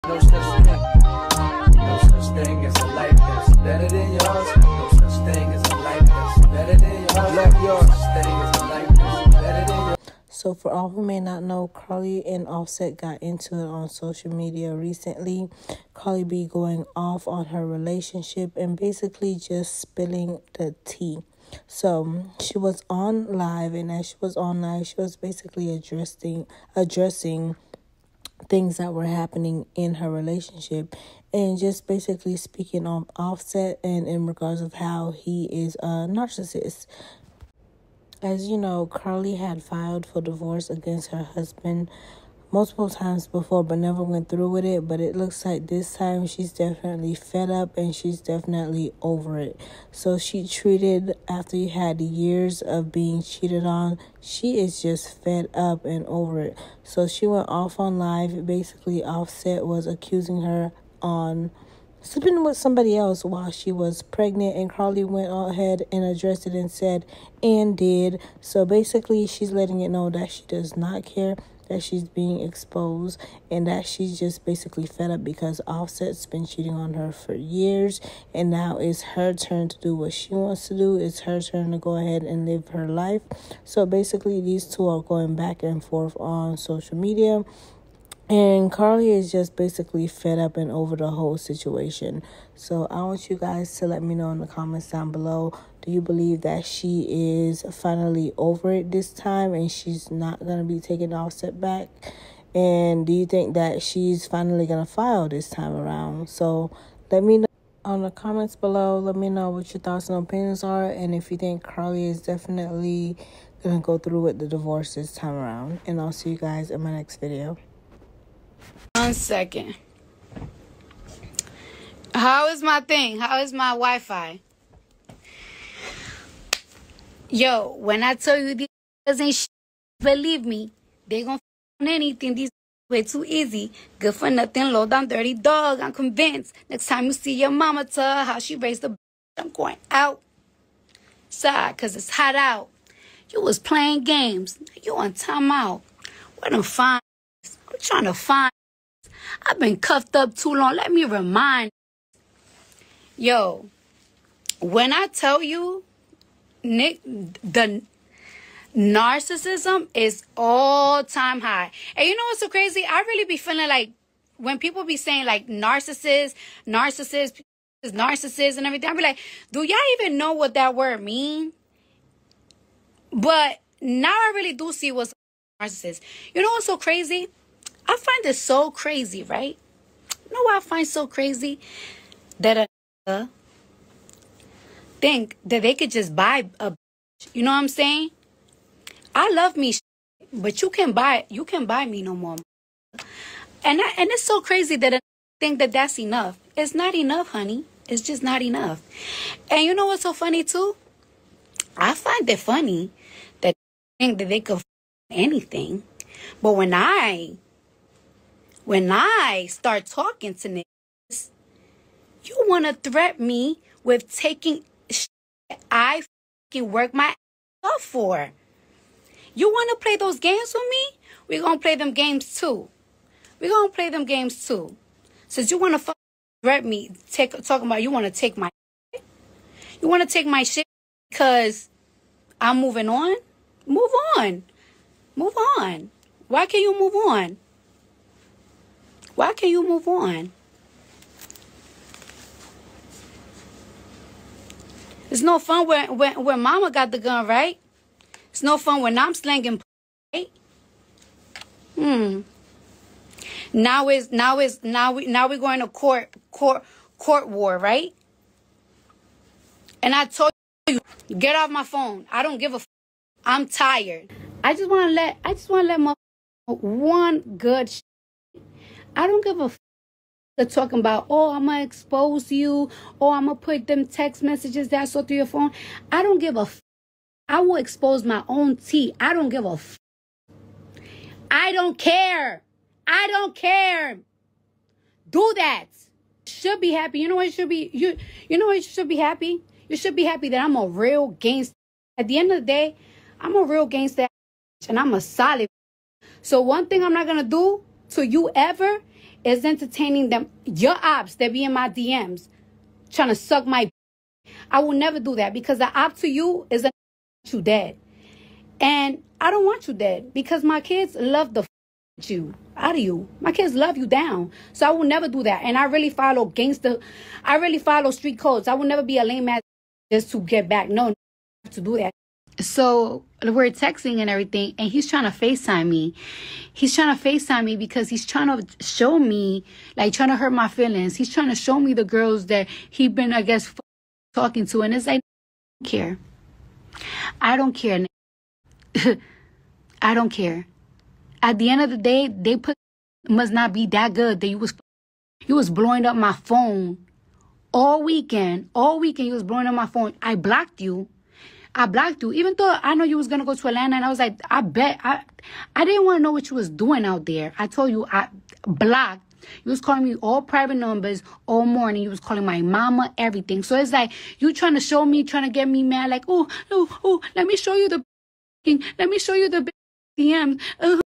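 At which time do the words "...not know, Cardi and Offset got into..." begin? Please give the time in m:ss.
0:11.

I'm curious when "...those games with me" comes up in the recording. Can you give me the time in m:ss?
3:39.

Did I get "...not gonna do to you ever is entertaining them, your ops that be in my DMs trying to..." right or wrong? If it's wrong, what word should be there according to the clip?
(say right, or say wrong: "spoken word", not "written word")
right.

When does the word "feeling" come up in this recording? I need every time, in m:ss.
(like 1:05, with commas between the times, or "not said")
2:43, 5:30.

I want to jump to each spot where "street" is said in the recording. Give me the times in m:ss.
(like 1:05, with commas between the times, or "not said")
5:17.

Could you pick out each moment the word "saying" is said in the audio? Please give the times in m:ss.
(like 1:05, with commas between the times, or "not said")
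2:44, 3:07.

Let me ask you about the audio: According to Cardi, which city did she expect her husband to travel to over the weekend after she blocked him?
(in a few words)
Atlanta.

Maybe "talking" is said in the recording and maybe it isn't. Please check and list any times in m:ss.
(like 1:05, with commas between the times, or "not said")
3:29, 3:47, 4:30, 5:34.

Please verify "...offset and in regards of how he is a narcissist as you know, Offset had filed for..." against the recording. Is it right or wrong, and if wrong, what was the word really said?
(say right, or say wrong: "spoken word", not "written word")
wrong: "Cardi", not "Offset".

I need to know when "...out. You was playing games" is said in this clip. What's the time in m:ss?
2:22.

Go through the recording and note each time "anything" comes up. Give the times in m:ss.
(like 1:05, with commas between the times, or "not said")
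2:11, 3:25.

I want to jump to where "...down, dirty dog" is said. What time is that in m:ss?
2:14.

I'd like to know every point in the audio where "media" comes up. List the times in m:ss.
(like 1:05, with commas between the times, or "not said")
0:14, 1:26.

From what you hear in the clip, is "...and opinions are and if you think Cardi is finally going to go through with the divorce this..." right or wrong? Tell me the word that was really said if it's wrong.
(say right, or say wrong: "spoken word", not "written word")
wrong: "definitely", not "finally".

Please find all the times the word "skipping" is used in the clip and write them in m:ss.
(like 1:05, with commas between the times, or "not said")
not said.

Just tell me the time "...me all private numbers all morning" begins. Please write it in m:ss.
5:59.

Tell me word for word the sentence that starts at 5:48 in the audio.
All weekend you was blowing up my phone.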